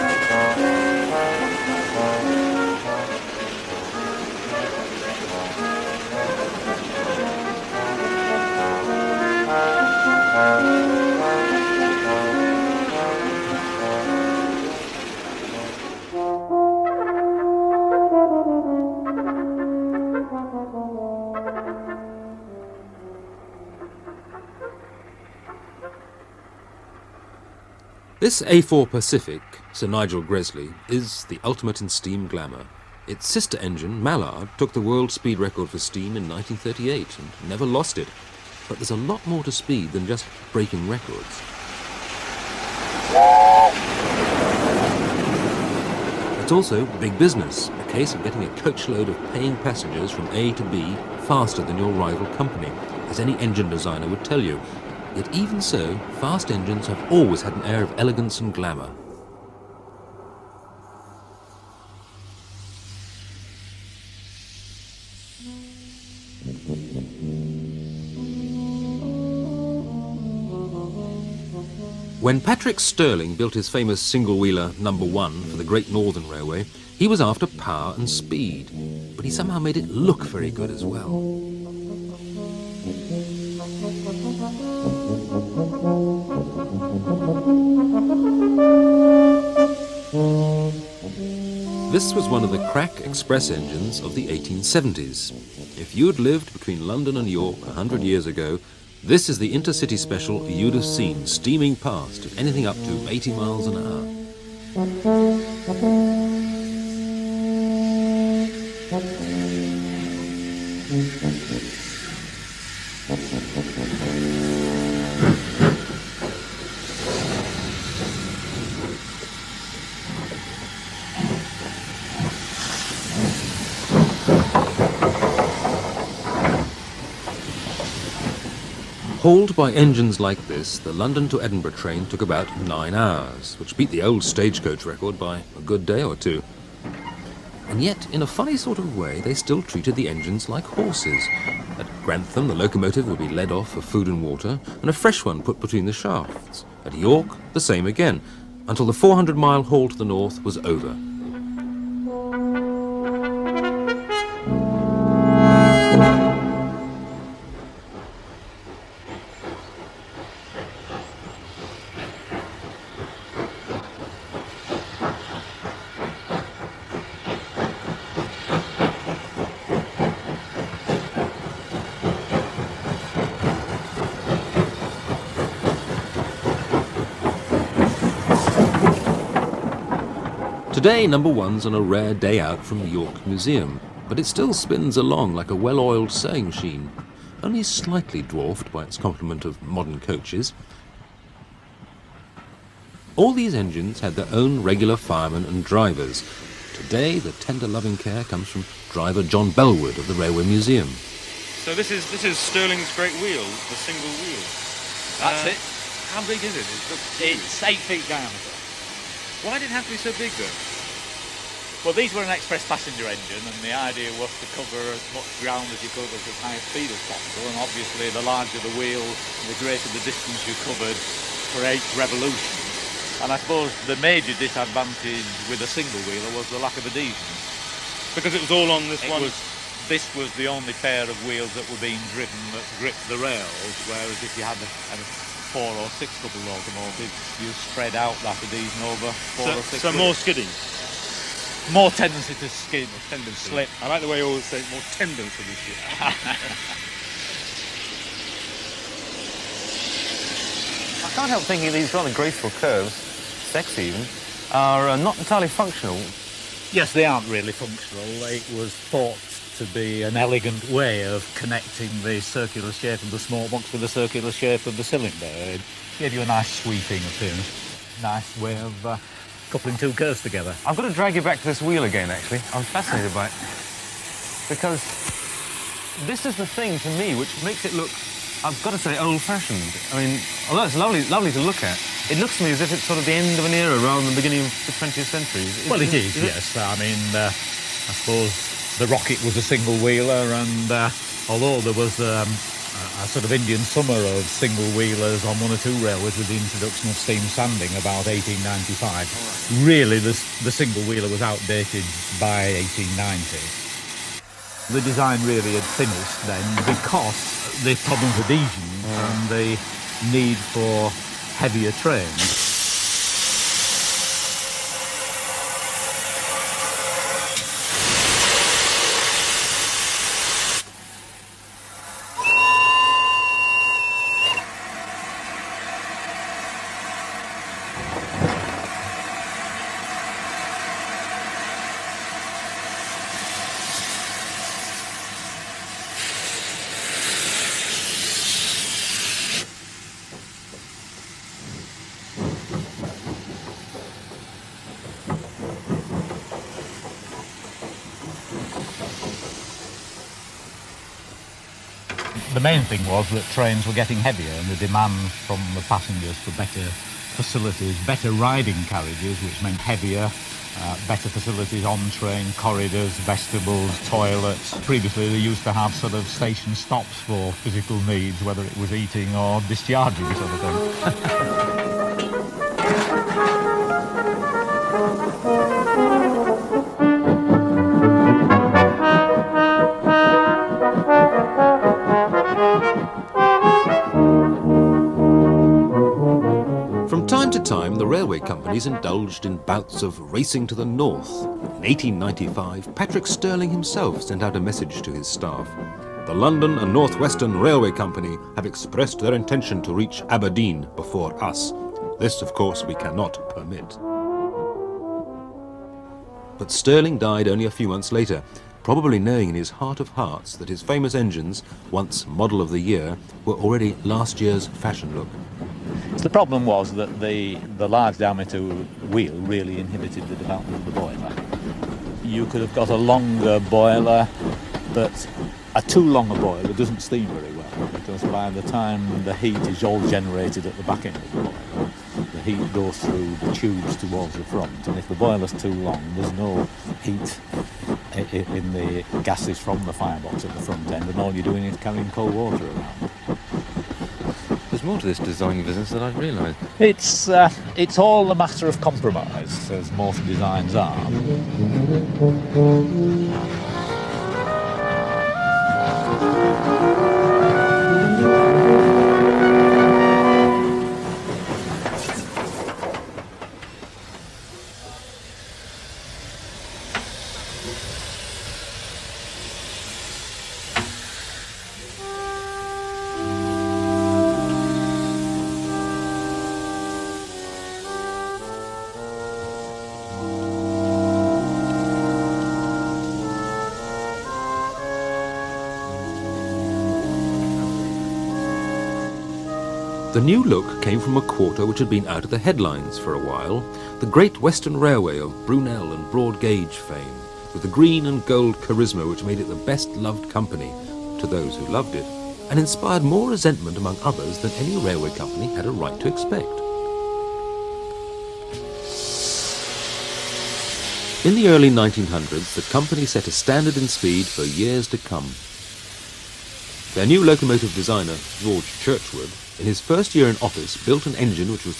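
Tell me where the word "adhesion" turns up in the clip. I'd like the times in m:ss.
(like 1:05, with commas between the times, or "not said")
3:46, 3:58, 5:08.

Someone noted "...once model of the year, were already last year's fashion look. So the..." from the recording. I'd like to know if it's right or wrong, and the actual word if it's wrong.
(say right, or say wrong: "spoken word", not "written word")
right.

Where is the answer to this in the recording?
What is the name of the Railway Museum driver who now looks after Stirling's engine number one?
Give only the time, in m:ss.
3:19.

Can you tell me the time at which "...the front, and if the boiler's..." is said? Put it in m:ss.
7:14.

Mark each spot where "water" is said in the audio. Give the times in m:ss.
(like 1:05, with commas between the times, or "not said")
2:24, 7:22.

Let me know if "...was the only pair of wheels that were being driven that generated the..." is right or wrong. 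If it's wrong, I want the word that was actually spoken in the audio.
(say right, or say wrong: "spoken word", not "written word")
wrong: "gripped", not "generated".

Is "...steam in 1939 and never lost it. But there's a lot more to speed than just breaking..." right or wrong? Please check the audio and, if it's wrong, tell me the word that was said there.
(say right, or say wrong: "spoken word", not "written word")
wrong: "1938", not "1939".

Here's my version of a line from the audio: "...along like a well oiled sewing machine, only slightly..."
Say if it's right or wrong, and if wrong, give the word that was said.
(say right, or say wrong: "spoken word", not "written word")
right.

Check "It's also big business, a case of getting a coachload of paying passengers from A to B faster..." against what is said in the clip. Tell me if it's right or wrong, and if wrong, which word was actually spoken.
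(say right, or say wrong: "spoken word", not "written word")
right.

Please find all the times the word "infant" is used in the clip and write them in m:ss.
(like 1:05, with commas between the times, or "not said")
not said.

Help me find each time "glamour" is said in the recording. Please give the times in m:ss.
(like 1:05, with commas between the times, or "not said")
0:32, 0:58.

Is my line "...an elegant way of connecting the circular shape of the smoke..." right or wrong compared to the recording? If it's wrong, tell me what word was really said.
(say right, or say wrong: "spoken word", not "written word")
right.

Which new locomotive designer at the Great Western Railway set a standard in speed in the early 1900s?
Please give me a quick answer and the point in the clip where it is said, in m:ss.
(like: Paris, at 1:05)
George Churchward, at 8:38.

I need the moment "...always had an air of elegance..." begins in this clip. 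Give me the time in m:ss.
0:57.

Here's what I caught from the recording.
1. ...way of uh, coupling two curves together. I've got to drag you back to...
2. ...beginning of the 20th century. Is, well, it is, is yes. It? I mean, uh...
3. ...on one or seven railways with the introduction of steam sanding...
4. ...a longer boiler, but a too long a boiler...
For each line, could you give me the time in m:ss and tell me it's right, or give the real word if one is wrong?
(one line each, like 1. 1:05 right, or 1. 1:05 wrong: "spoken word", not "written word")
1. 4:28 right
2. 4:44 right
3. 4:55 wrong: "two", not "seven"
4. 7:02 right.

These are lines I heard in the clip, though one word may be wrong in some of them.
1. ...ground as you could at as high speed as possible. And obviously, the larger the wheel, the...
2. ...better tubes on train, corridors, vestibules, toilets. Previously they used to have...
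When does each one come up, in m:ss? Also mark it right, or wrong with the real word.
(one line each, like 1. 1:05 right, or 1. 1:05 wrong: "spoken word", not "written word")
1. 3:35 right
2. 6:00 wrong: "facilities", not "tubes".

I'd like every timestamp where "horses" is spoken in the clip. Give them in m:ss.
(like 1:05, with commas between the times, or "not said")
2:20.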